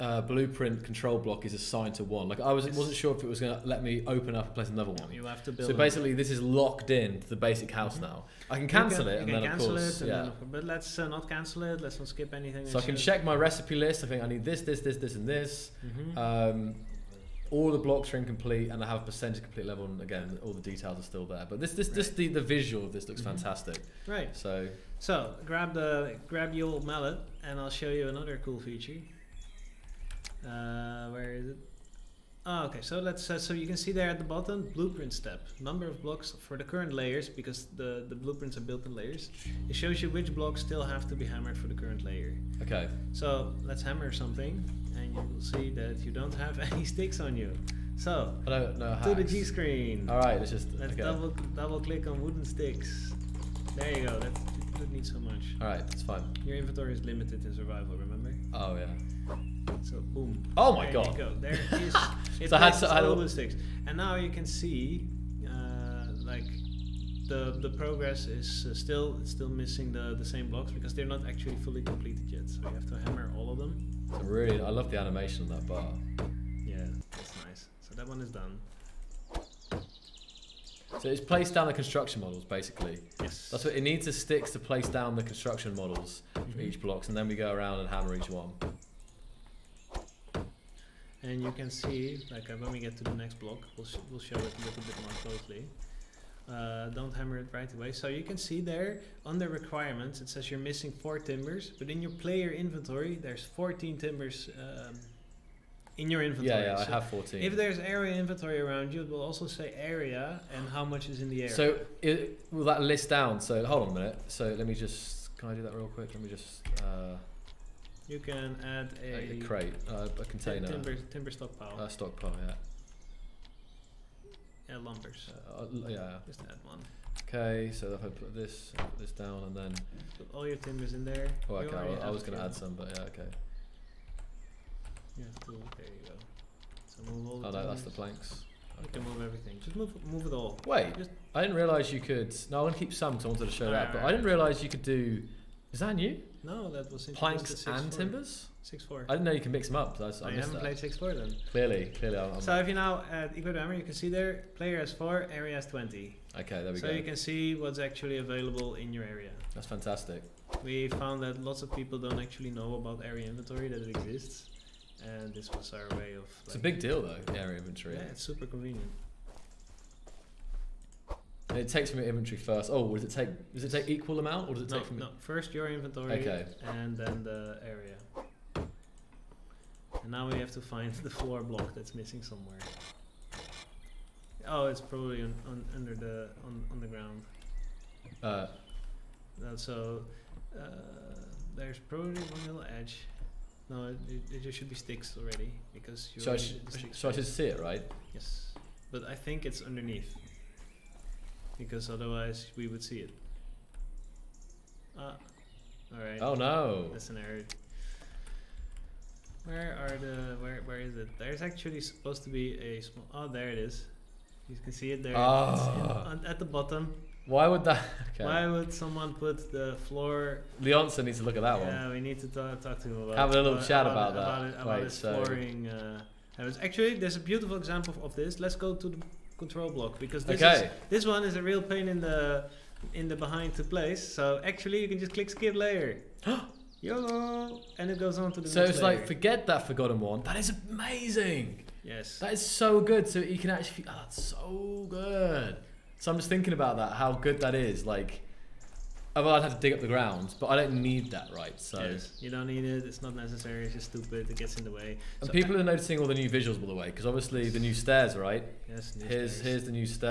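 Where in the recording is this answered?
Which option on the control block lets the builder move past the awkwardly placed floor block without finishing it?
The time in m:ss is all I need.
3:55.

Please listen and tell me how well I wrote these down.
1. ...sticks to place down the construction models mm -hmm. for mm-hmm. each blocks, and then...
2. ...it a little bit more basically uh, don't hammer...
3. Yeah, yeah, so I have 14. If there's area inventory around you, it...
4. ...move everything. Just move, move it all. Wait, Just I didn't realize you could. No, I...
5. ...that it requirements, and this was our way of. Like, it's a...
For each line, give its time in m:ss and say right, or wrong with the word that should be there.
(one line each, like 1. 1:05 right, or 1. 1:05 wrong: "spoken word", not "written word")
1. 1:24 right
2. 1:34 wrong: "closely", not "basically"
3. 1:46 right
4. 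2:19 right
5. 2:43 wrong: "exists", not "requirements".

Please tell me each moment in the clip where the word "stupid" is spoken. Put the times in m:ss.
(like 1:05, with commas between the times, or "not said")
4:13.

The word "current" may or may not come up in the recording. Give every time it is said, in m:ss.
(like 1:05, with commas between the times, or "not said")
0:36, 0:41.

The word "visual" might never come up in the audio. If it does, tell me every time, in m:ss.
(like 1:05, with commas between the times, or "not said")
0:22, 4:16.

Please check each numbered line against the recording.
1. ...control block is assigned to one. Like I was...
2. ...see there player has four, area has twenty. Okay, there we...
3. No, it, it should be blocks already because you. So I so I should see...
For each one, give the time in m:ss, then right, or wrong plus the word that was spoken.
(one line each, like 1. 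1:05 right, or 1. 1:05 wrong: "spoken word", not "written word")
1. 0:00 right
2. 2:33 right
3. 3:13 wrong: "sticks", not "blocks".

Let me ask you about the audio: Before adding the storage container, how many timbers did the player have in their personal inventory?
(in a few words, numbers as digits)
14.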